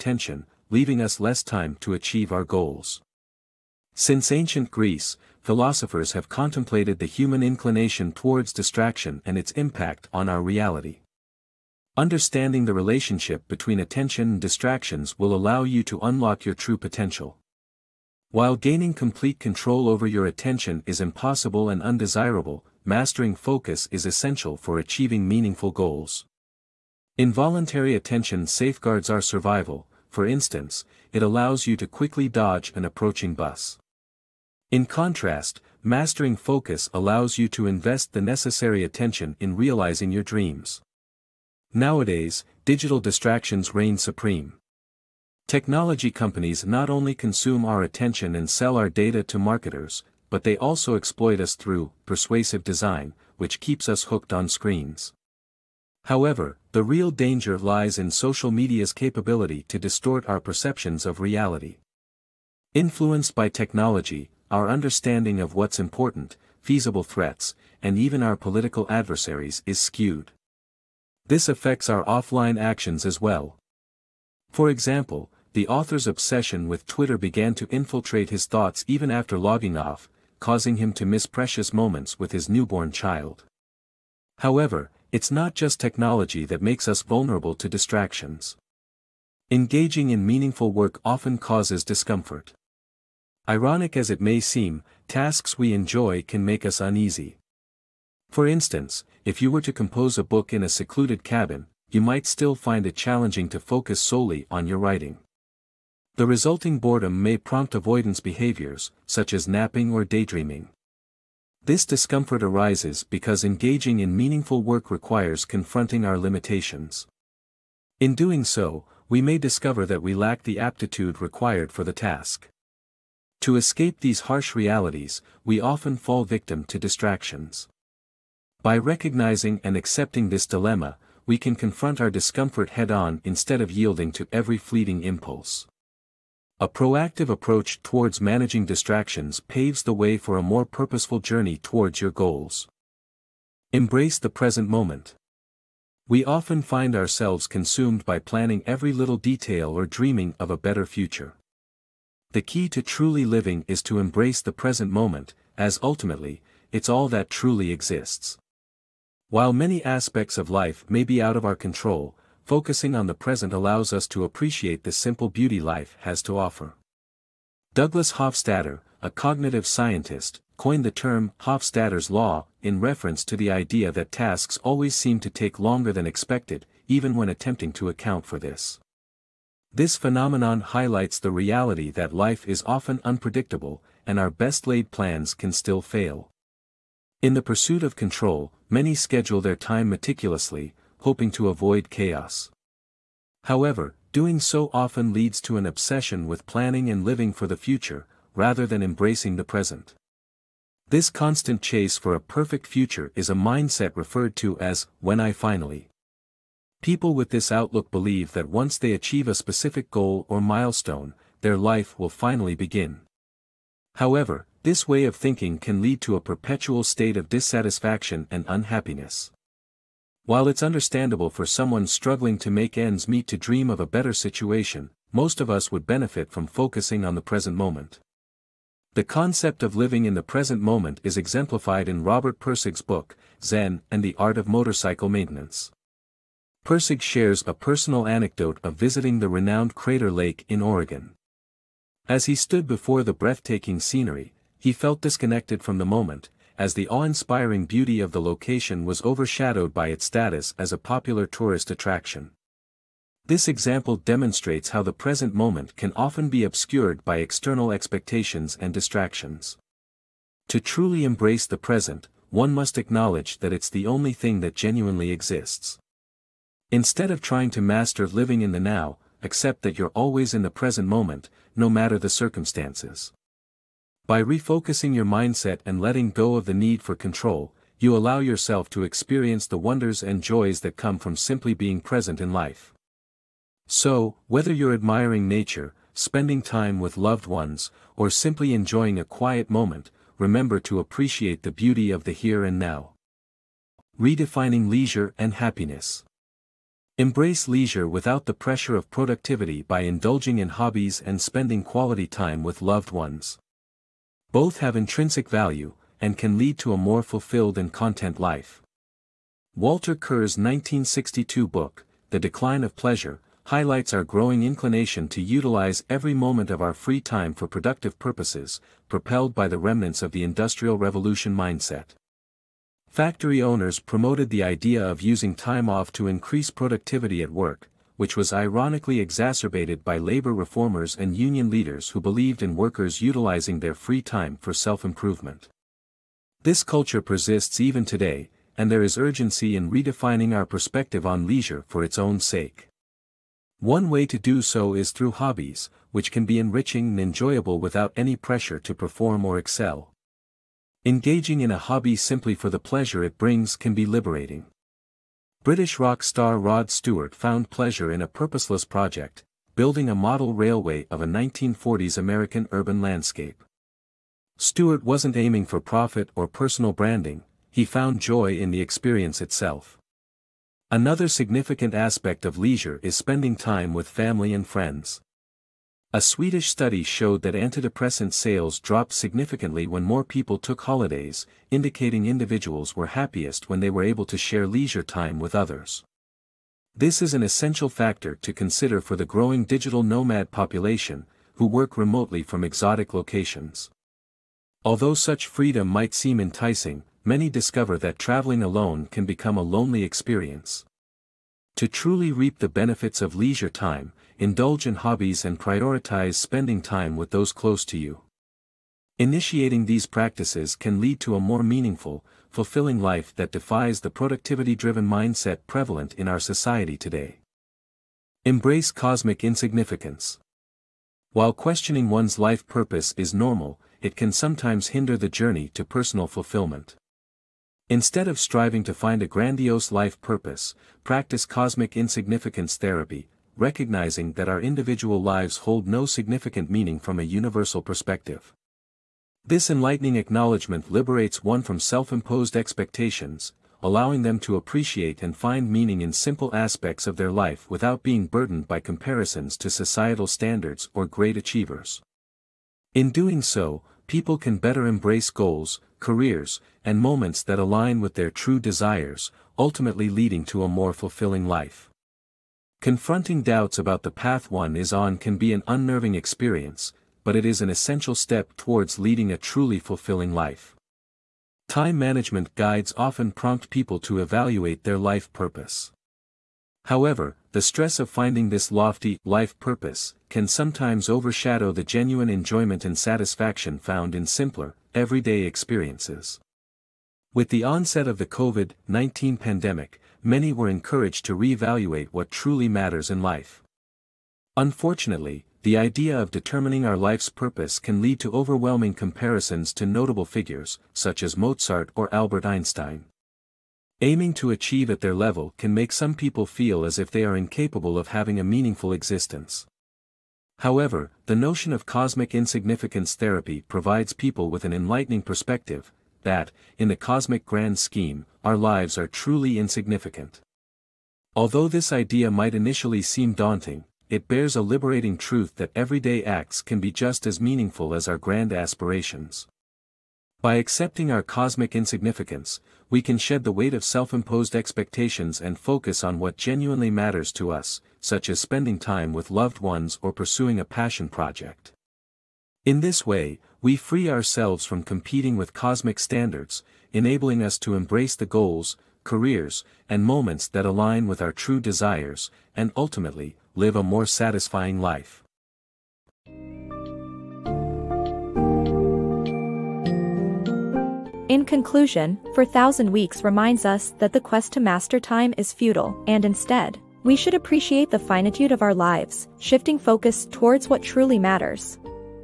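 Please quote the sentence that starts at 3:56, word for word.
Pirsig shares a personal anecdote of visiting the renowned Crater Lake in Oregon.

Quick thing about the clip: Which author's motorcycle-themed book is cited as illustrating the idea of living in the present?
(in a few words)
Robert Pirsig.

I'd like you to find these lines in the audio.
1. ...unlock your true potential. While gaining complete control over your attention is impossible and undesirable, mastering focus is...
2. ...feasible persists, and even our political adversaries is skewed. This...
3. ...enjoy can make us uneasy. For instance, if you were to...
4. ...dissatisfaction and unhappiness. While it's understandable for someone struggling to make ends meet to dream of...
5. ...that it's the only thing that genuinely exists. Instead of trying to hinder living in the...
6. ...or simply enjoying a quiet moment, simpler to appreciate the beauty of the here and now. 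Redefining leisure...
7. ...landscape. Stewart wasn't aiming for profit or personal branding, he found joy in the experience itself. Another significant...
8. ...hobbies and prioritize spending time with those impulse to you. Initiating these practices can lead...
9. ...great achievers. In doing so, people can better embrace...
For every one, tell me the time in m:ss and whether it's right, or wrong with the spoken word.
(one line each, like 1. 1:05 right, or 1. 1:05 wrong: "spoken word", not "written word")
1. 0:15 right
2. 1:06 wrong: "threats", not "persists"
3. 1:35 right
4. 3:37 right
5. 4:23 wrong: "master", not "hinder"
6. 4:47 wrong: "remember", not "simpler"
7. 6:02 right
8. 6:44 wrong: "close", not "impulse"
9. 7:30 right.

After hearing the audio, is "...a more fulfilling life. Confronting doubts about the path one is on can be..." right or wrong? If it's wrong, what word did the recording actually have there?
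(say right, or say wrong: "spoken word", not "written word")
right.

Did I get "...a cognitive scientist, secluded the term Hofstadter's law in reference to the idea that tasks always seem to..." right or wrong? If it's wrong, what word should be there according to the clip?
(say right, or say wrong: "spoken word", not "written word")
wrong: "coined", not "secluded".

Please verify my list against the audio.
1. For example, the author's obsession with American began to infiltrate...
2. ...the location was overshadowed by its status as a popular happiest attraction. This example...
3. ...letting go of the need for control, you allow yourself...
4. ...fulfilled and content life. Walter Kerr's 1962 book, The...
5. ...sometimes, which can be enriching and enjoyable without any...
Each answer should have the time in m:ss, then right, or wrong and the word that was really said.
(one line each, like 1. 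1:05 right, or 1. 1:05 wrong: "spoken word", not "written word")
1. 1:14 wrong: "Twitter", not "American"
2. 4:08 wrong: "tourist", not "happiest"
3. 4:35 right
4. 5:07 right
5. 5:45 wrong: "hobbies", not "sometimes".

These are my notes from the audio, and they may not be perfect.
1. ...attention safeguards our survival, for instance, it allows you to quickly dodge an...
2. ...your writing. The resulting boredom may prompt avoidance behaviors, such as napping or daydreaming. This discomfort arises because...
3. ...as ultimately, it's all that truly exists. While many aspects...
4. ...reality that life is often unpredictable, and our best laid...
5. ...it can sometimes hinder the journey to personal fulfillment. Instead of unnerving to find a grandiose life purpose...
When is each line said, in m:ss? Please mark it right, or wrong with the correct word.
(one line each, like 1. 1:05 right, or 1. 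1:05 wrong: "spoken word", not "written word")
1. 0:27 right
2. 1:44 right
3. 2:35 right
4. 3:01 right
5. 7:03 wrong: "striving", not "unnerving".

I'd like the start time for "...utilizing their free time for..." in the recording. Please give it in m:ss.
5:33.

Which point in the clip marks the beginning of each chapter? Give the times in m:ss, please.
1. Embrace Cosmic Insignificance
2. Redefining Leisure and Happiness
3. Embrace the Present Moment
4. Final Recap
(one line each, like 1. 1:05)
1. 6:58
2. 4:53
3. 2:23
4. 9:15.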